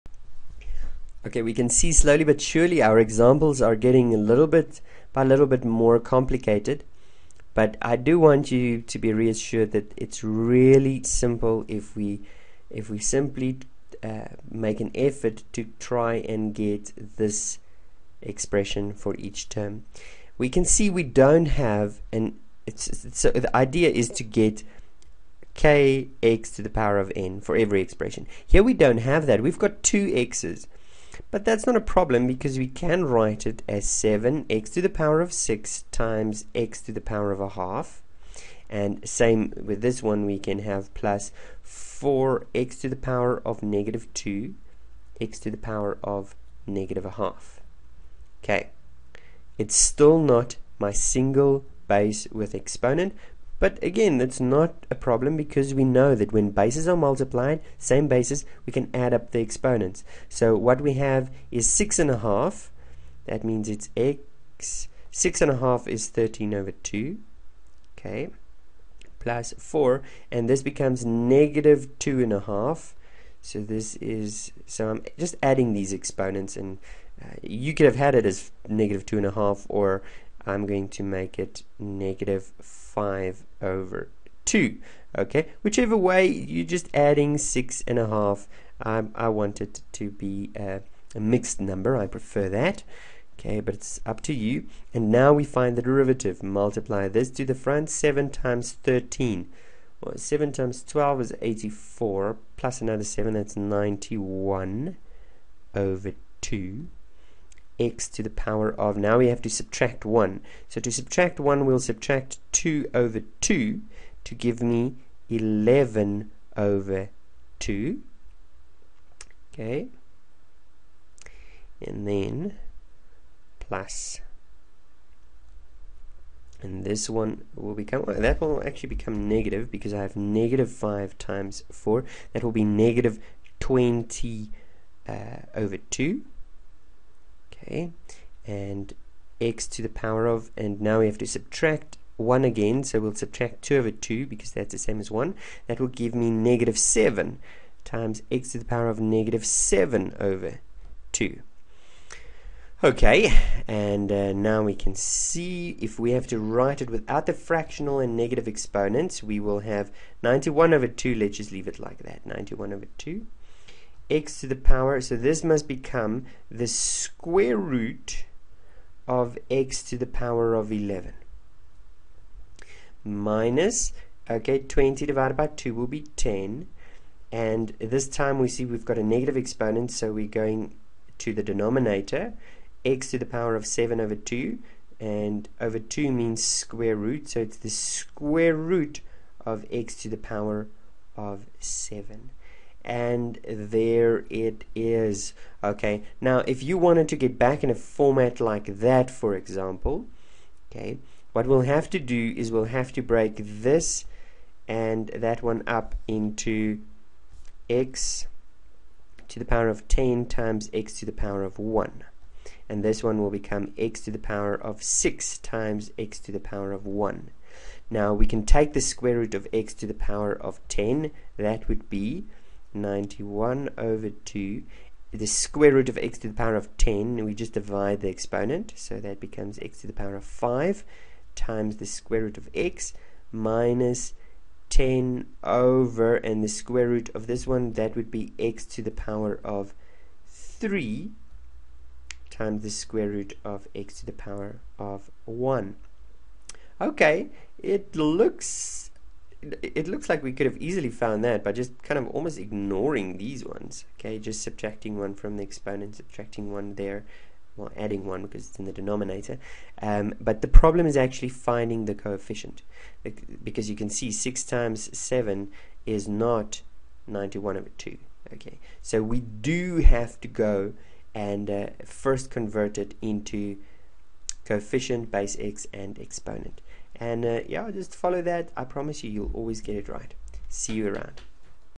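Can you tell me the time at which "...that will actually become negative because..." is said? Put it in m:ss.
2:08.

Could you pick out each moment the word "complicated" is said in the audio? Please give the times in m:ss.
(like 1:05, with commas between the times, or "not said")
0:05.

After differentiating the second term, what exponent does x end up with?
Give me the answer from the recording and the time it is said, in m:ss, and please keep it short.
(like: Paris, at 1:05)
-7/2, at 2:28.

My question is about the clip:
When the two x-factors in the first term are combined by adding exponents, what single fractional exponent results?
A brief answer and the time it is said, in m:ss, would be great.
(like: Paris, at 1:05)
13/2, at 1:06.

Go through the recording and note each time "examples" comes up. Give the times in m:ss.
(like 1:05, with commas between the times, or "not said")
0:02, 3:19.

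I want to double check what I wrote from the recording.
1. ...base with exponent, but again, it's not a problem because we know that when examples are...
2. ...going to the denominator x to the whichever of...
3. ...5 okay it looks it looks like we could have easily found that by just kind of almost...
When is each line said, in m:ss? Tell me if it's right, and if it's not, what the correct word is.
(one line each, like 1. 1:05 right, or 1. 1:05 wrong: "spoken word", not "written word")
1. 0:51 wrong: "bases", not "examples"
2. 3:00 wrong: "power", not "whichever"
3. 4:05 wrong: "1", not "5".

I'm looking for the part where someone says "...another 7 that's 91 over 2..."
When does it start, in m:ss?
1:42.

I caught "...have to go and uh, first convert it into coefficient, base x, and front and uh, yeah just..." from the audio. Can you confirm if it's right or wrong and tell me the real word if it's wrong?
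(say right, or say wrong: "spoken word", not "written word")
wrong: "exponent", not "front".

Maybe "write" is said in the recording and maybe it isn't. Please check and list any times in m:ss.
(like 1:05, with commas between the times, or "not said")
0:33, 2:36.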